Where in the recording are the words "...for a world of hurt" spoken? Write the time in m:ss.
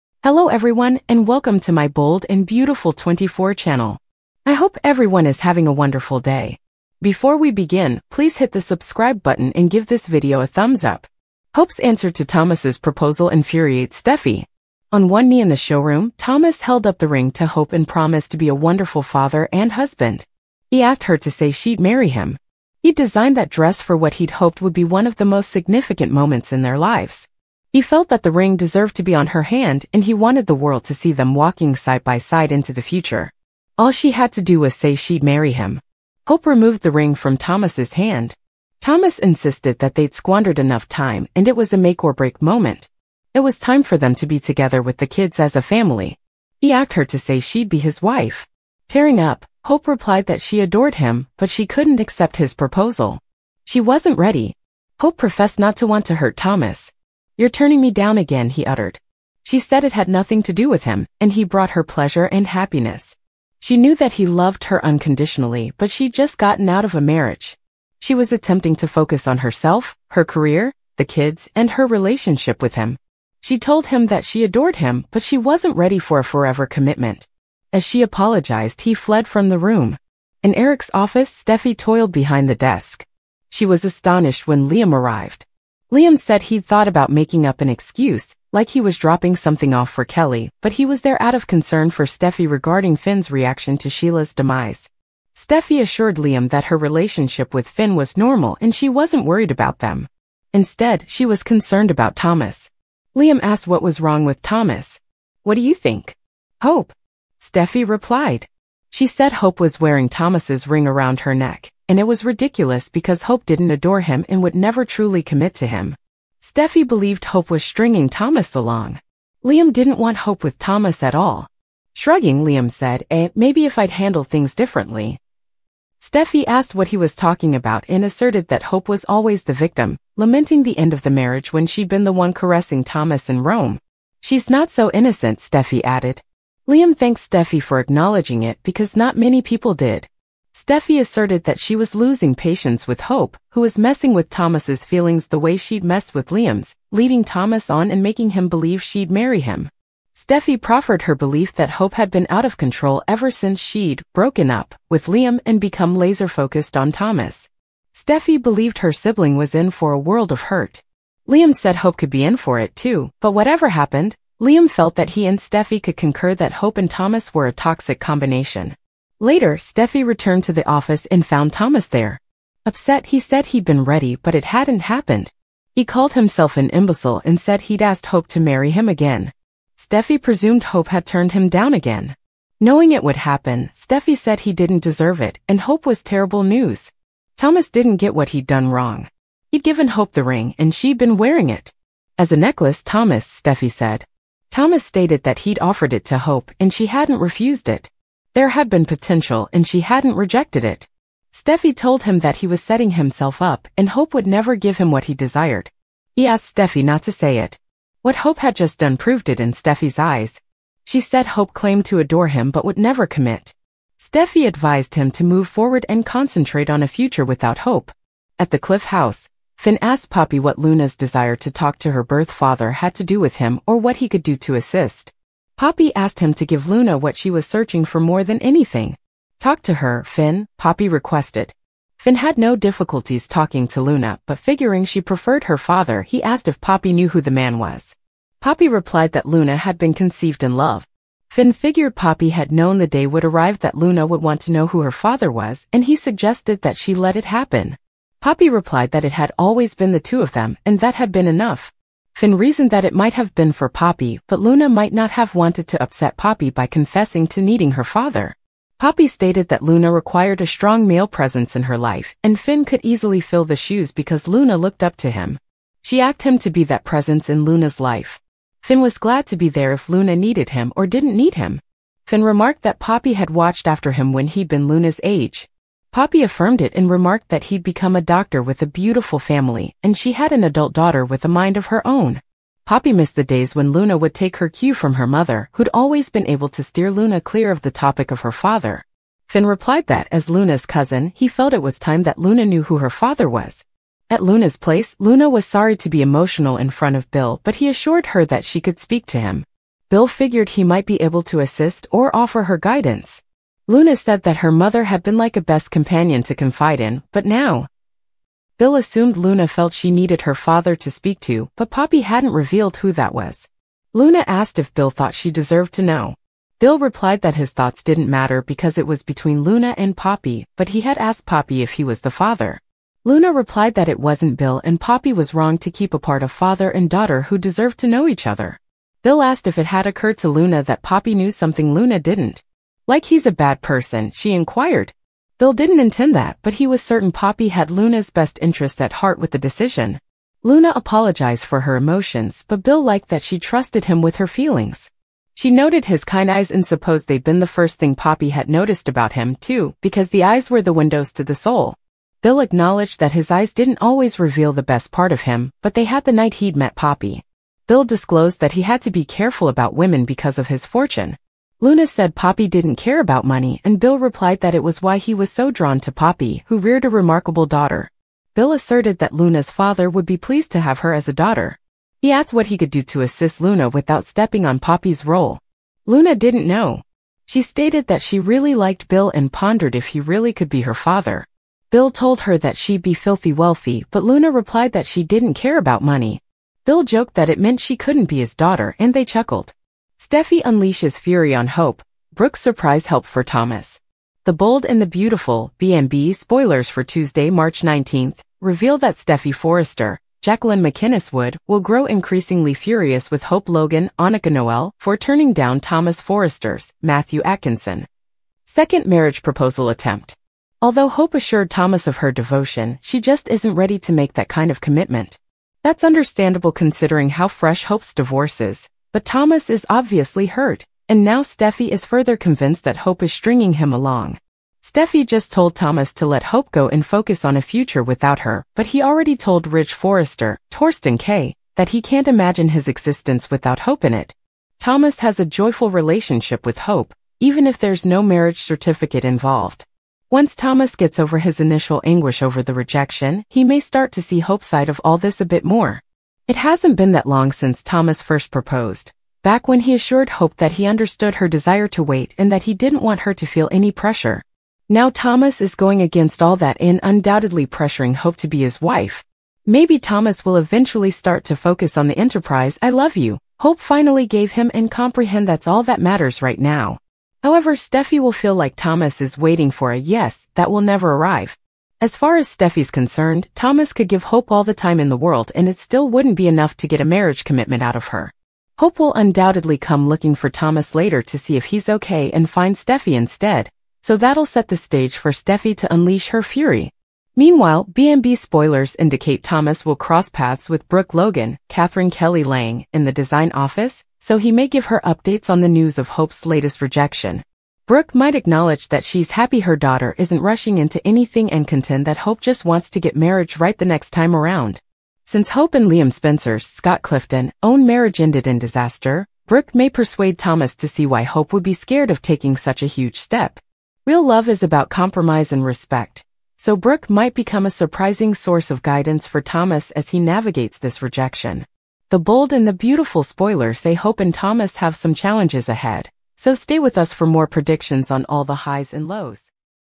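2:39.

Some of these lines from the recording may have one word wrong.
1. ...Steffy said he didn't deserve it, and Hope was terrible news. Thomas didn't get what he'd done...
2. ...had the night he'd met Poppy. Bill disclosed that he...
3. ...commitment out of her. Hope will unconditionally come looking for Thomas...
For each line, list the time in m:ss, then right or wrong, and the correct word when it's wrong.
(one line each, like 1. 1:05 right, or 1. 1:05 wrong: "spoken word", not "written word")
1. 3:03 right
2. 5:55 right
3. 7:57 wrong: "undoubtedly", not "unconditionally".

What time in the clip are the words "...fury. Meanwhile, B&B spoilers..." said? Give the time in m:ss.
8:06.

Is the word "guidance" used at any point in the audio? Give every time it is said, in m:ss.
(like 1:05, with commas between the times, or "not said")
5:02, 8:38.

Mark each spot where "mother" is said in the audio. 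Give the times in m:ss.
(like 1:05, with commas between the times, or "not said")
4:45, 5:04.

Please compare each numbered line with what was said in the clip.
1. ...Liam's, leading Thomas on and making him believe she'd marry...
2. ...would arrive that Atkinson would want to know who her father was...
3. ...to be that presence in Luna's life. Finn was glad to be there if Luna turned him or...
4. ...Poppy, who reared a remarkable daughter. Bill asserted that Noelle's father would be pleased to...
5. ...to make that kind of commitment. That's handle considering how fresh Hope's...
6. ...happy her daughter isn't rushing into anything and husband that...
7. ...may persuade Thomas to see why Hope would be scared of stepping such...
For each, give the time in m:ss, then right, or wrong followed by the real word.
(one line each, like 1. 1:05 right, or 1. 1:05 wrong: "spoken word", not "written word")
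1. 2:26 right
2. 4:03 wrong: "Luna", not "Atkinson"
3. 4:26 wrong: "needed", not "turned"
4. 6:05 wrong: "Luna", not "Noelle"
5. 6:53 wrong: "understandable", not "handle"
6. 8:19 wrong: "contend", not "husband"
7. 8:29 wrong: "taking", not "stepping".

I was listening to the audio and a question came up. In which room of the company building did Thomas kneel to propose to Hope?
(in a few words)
Showroom.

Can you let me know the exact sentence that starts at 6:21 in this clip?
Bill told her that she'd be filthy wealthy, but Luna replied that she didn't care about money.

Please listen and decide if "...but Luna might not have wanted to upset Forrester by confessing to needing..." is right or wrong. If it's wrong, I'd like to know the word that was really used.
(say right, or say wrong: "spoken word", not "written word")
wrong: "Poppy", not "Forrester".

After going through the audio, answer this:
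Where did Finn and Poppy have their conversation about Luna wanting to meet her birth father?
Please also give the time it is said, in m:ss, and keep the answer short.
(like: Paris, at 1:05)
The Cliff House, at 3:38.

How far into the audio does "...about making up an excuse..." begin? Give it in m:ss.
1:26.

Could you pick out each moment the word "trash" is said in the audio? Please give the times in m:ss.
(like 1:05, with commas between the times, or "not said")
not said.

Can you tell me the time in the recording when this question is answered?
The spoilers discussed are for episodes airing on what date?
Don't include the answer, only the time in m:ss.
6:36.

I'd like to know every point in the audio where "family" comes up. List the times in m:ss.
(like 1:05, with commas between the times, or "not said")
0:45, 4:39.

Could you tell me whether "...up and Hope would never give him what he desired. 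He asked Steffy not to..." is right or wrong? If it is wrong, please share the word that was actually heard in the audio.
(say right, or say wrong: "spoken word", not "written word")
right.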